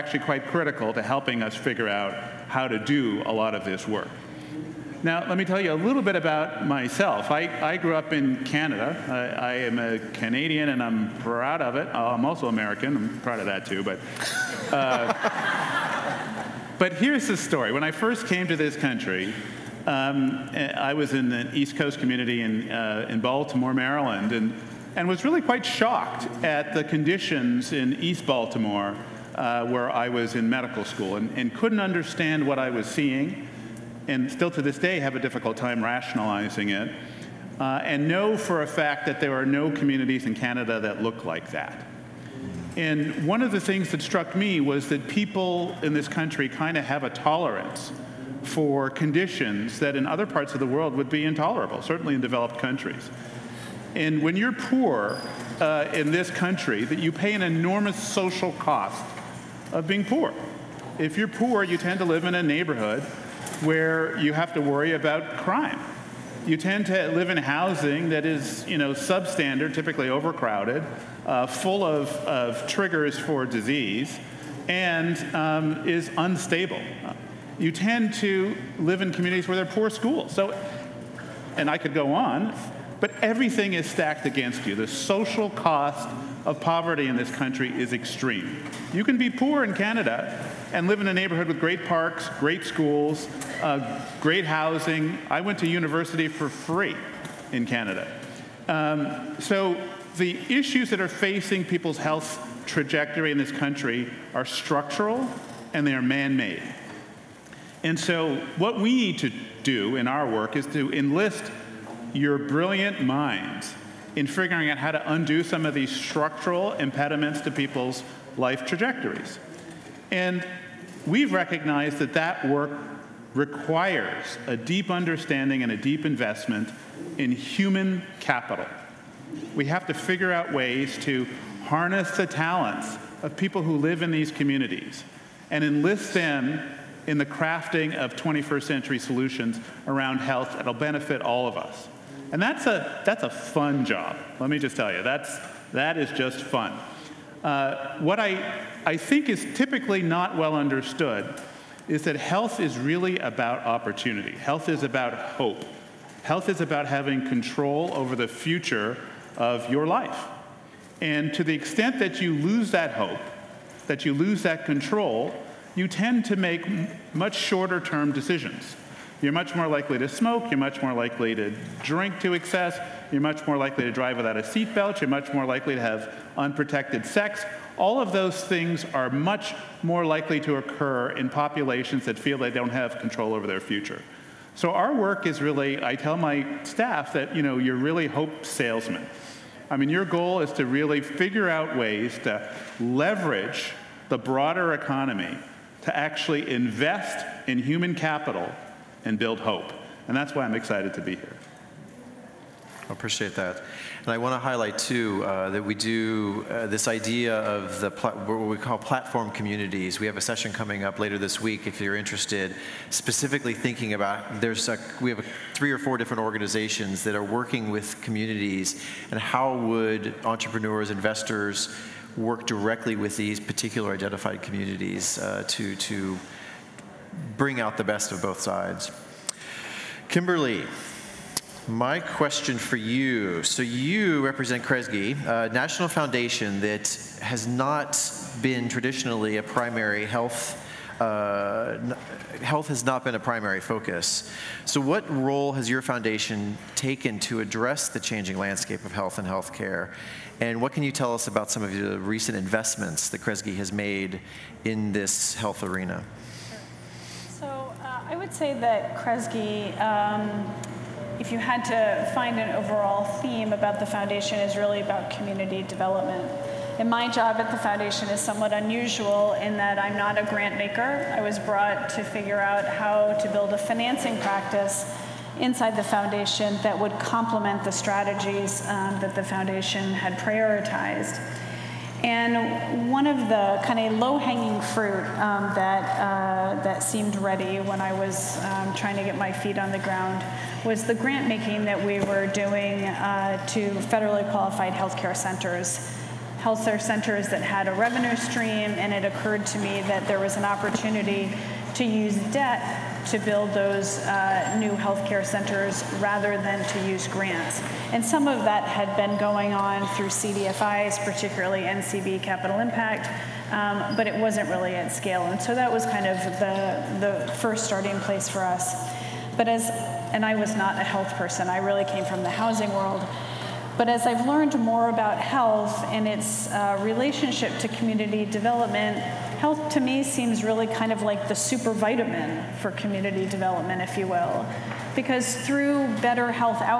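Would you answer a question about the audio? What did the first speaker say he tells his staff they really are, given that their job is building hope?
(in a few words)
hope salesmen.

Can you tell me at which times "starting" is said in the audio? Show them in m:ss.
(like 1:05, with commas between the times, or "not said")
5:17.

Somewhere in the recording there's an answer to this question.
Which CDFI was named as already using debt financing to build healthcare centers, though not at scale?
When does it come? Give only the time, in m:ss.
5:11.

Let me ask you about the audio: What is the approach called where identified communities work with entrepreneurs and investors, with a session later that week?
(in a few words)
platform communities.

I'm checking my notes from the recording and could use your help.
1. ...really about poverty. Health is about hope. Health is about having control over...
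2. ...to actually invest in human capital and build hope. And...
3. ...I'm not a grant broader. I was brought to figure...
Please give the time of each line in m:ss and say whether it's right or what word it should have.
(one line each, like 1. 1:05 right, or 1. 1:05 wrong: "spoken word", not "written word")
1. 2:32 wrong: "opportunity", not "poverty"
2. 3:15 right
3. 4:29 wrong: "maker", not "broader".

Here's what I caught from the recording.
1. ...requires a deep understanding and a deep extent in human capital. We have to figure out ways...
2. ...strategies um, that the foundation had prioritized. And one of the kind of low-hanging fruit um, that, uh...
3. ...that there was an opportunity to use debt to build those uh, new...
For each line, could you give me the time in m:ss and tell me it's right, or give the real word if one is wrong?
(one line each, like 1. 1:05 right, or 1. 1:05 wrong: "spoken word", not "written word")
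1. 2:03 wrong: "investment", not "extent"
2. 4:37 right
3. 4:59 right.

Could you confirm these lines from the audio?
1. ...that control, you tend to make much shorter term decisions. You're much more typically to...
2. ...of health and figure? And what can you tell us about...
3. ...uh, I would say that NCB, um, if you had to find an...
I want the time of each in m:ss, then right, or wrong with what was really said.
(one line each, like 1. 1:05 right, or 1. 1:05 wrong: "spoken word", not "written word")
1. 2:44 wrong: "likely", not "typically"
2. 4:08 wrong: "healthcare", not "figure"
3. 4:17 wrong: "Kresge", not "NCB".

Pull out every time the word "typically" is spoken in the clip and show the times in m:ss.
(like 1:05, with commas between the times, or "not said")
1:09, 2:29.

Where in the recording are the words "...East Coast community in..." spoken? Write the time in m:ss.
0:21.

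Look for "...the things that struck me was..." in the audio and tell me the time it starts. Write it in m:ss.
0:43.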